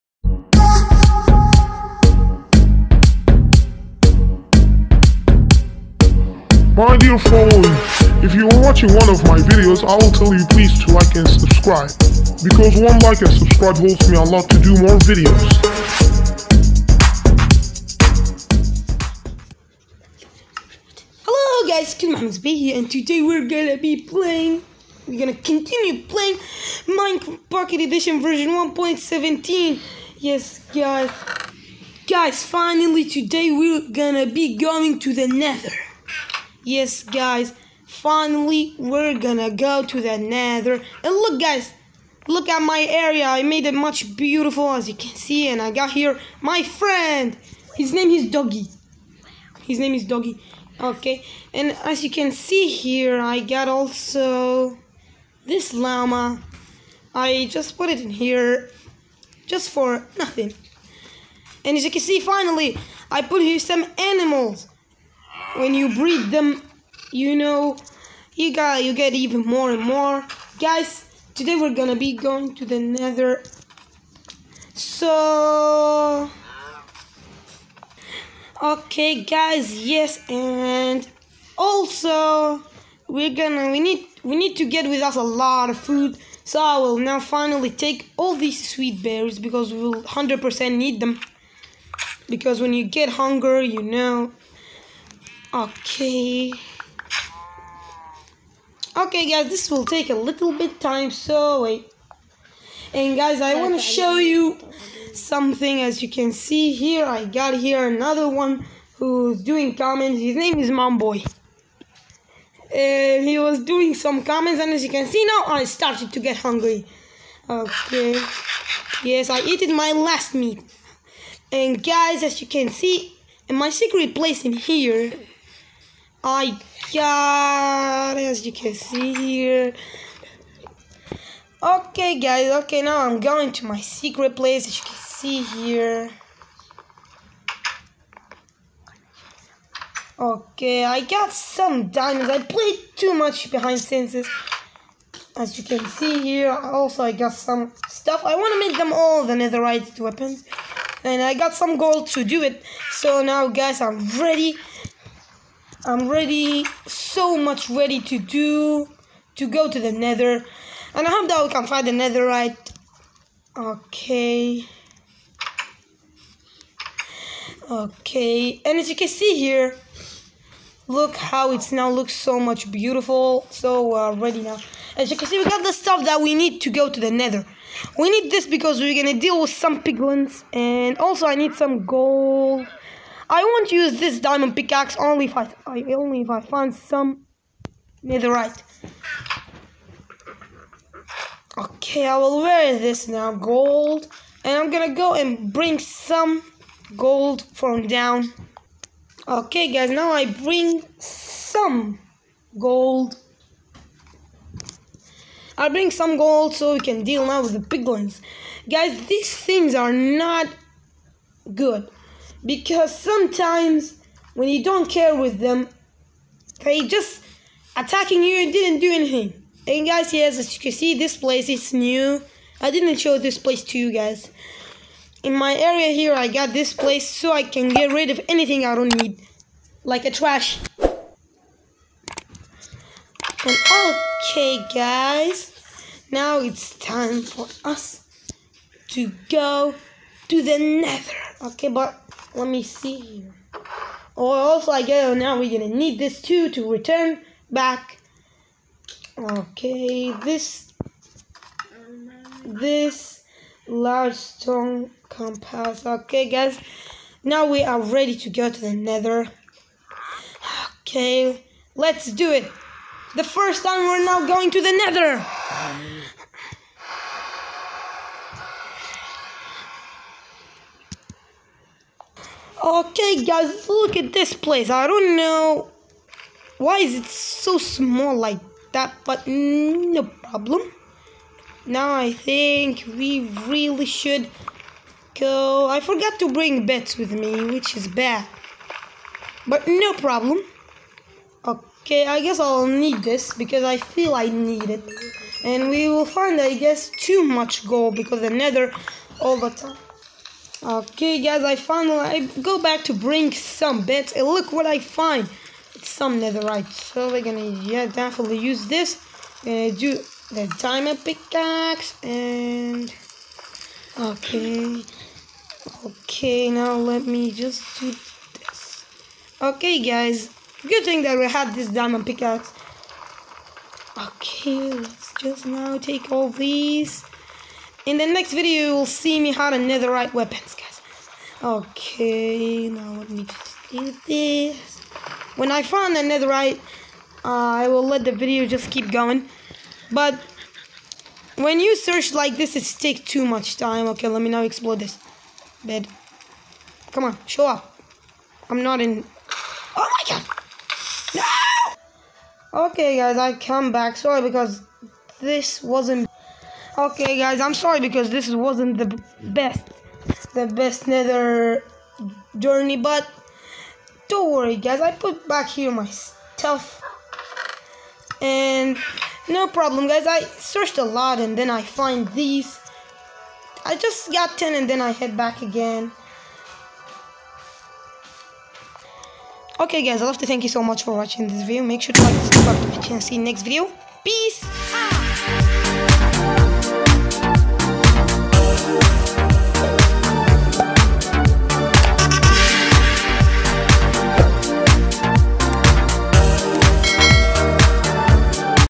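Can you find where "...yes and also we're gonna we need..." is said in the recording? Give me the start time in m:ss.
1:19.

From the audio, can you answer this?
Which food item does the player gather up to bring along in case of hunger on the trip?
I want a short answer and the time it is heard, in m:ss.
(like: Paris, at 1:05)
Sweet berries, at 1:28.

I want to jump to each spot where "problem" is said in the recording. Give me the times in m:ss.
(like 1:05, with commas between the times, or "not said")
4:40, 4:49, 6:09.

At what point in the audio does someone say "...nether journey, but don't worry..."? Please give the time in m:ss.
6:00.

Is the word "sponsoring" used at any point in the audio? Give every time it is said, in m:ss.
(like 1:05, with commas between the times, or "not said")
not said.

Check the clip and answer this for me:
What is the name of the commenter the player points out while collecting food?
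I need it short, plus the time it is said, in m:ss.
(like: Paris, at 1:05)
Momboy, at 1:50.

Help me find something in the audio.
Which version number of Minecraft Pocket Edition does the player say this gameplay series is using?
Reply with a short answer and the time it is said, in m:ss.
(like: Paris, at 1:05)
1.17, at 0:28.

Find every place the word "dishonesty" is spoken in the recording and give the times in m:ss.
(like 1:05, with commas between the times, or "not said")
not said.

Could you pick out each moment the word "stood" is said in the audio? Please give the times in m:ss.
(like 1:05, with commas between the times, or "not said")
not said.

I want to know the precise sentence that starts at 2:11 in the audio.
Okay guys, okay now I'm going to my secret place as you can see here.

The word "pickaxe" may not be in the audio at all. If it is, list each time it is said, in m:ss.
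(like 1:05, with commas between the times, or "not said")
3:04, 5:11, 5:22.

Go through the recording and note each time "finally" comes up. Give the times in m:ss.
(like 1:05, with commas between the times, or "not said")
0:32, 0:37, 1:02, 1:27, 5:01.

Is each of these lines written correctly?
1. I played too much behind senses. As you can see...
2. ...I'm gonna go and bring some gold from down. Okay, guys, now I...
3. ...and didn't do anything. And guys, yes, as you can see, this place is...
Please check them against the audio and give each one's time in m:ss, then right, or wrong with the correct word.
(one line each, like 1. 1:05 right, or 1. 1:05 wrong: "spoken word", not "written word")
1. 2:22 right
2. 3:14 right
3. 3:38 right.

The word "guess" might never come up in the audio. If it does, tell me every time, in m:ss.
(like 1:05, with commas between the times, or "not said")
4:04, 4:52, 4:56.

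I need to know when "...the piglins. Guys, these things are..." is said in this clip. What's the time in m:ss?
3:27.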